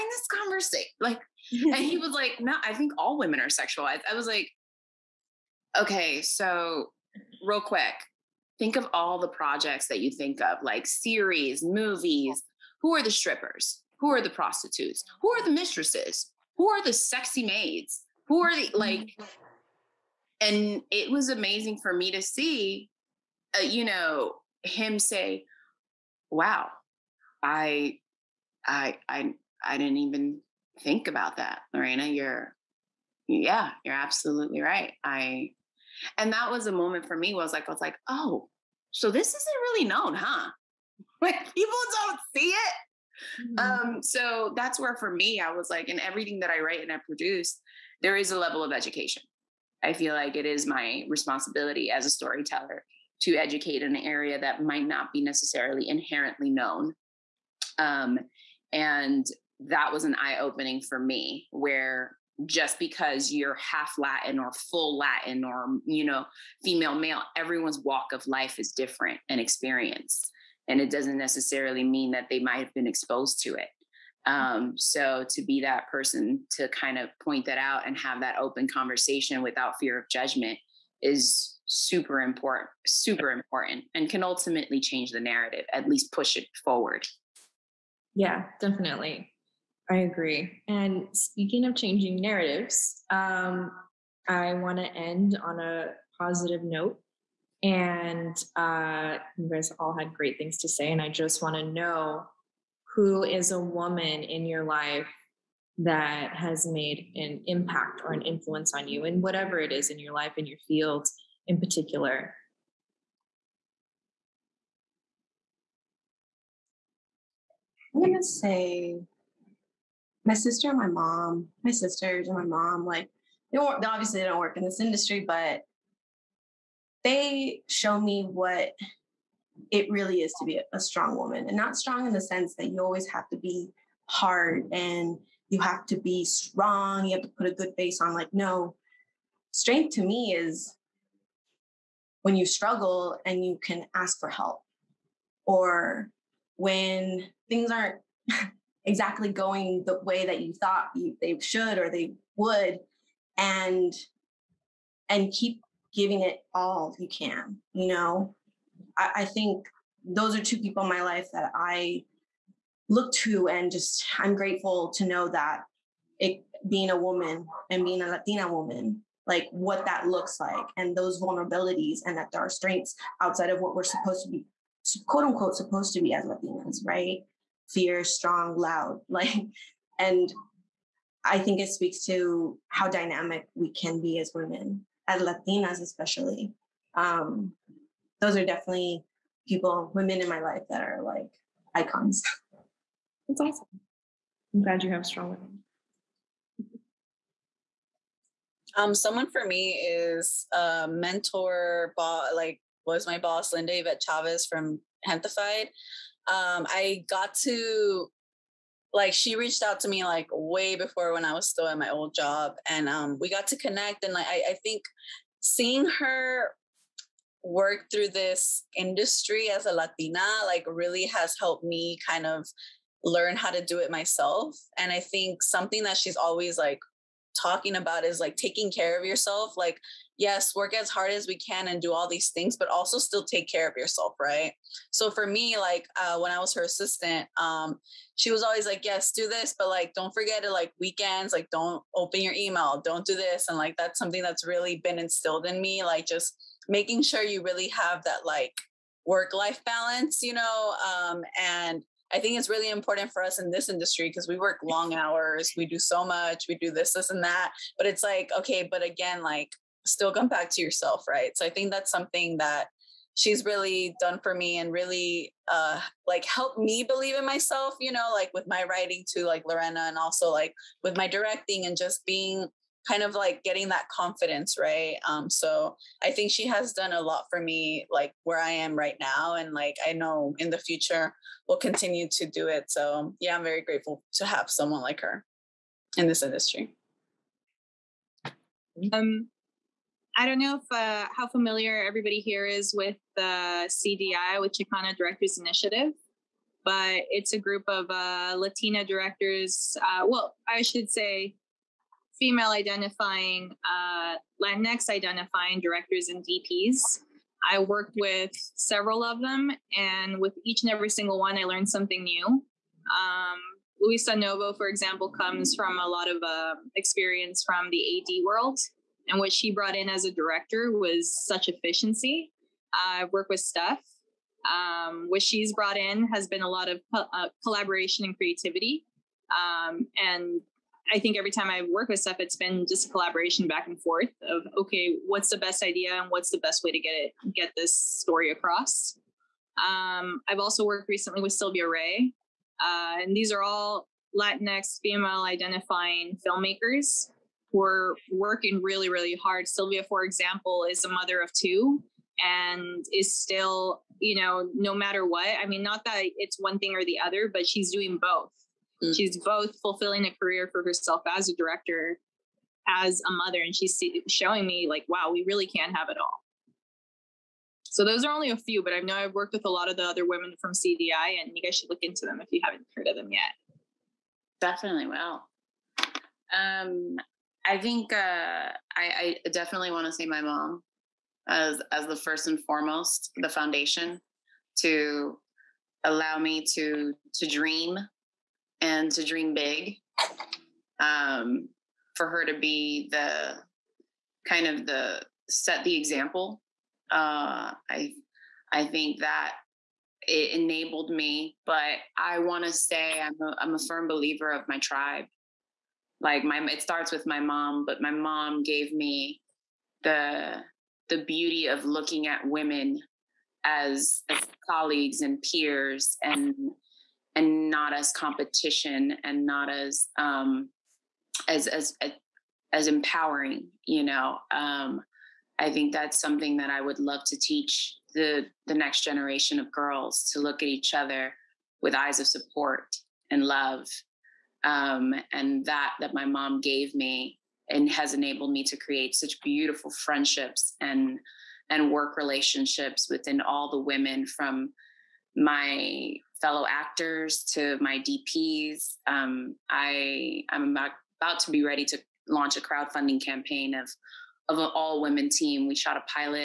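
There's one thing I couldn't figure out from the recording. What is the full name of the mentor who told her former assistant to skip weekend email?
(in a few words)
Linda Yvette Chavez.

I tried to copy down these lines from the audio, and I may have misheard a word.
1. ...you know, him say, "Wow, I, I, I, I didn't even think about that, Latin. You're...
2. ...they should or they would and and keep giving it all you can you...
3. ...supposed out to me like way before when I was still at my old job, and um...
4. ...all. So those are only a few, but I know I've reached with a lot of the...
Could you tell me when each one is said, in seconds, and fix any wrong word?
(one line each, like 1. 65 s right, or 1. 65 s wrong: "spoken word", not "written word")
1. 23 s wrong: "Lorena", not "Latin"
2. 151 s right
3. 209 s wrong: "reached", not "supposed"
4. 365 s wrong: "worked", not "reached".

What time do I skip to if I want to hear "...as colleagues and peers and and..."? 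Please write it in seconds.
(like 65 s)
414 s.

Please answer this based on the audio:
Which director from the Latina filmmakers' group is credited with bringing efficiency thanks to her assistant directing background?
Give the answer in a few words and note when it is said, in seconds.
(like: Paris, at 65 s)
Luisa Novo, at 313 s.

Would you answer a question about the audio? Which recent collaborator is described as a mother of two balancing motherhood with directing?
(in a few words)
Sylvia Ray.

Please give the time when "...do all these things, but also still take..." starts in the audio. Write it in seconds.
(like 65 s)
231 s.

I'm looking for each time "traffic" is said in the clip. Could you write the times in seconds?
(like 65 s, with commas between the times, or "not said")
not said.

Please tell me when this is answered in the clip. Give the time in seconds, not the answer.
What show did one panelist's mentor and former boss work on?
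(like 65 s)
205 s.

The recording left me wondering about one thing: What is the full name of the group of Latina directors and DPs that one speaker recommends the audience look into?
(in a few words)
Chicana Directors Initiative.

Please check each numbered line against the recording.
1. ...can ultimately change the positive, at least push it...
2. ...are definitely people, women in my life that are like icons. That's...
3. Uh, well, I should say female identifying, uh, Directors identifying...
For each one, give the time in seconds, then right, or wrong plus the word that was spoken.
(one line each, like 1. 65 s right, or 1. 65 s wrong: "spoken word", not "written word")
1. 84 s wrong: "narrative", not "positive"
2. 188 s right
3. 299 s wrong: "Latinx", not "Directors".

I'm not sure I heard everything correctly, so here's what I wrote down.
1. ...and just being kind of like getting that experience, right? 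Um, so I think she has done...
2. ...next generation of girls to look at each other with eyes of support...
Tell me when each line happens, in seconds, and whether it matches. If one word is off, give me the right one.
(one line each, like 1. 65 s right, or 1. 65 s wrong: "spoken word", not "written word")
1. 271 s wrong: "confidence", not "experience"
2. 428 s right.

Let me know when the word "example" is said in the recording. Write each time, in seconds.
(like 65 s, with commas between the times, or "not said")
314 s, 350 s, 395 s.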